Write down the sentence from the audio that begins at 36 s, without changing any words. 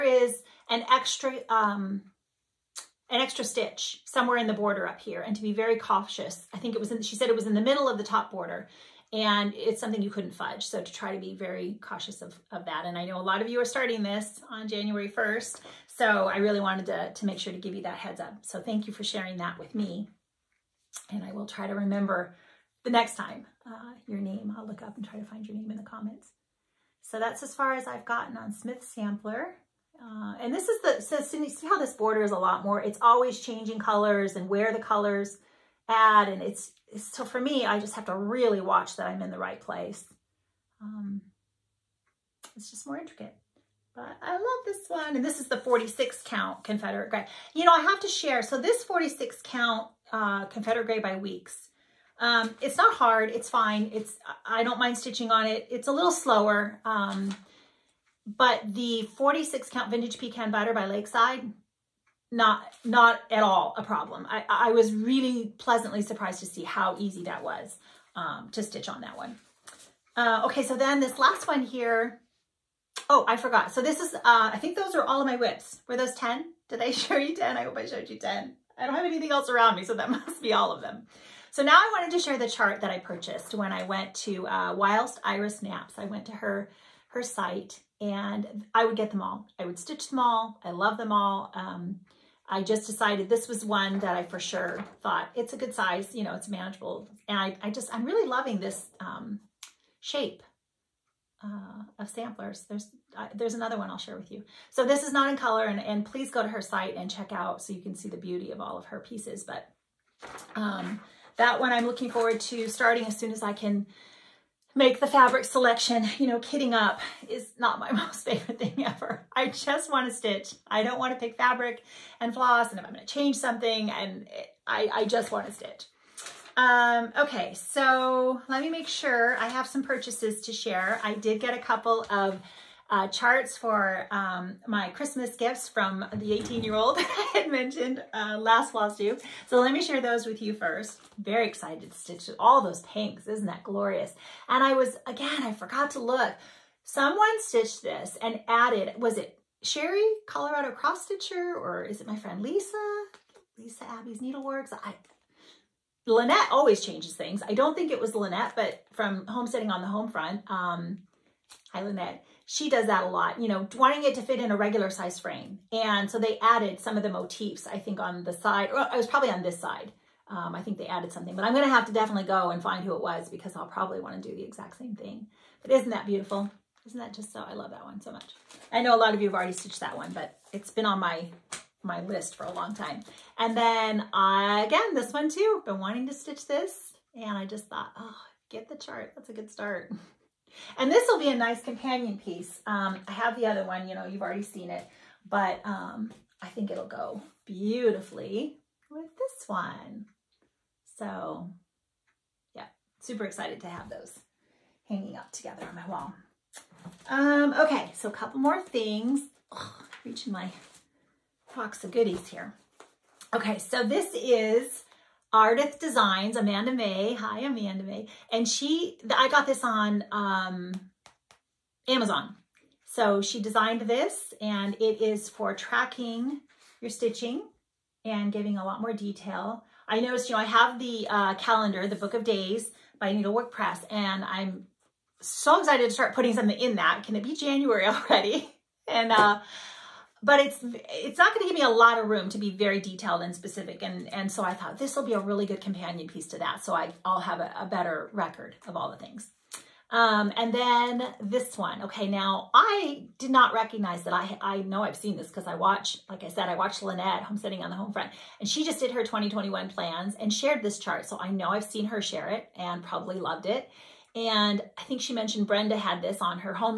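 And it's, so for me, I just have to really watch that I'm in the right place.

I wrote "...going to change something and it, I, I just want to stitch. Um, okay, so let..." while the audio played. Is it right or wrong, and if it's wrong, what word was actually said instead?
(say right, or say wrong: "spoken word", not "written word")
right.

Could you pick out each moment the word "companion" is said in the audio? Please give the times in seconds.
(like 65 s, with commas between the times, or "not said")
191 s, 245 s.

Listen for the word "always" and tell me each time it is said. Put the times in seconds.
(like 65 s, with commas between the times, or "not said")
33 s, 156 s.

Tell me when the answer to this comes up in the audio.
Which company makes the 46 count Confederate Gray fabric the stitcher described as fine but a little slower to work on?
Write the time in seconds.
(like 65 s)
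51 s.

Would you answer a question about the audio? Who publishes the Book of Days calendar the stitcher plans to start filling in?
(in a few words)
Needlework Press.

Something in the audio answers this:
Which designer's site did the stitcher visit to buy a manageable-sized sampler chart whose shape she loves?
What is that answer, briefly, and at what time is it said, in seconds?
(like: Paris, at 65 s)
Whilst Iris Naps, at 84 s.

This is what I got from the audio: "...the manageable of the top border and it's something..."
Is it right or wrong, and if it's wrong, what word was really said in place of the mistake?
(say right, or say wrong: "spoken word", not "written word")
wrong: "middle", not "manageable".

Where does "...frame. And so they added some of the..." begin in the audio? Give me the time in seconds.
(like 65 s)
165 s.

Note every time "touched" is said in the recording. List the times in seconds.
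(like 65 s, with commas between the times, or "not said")
not said.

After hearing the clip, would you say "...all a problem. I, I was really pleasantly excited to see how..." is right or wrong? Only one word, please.
wrong.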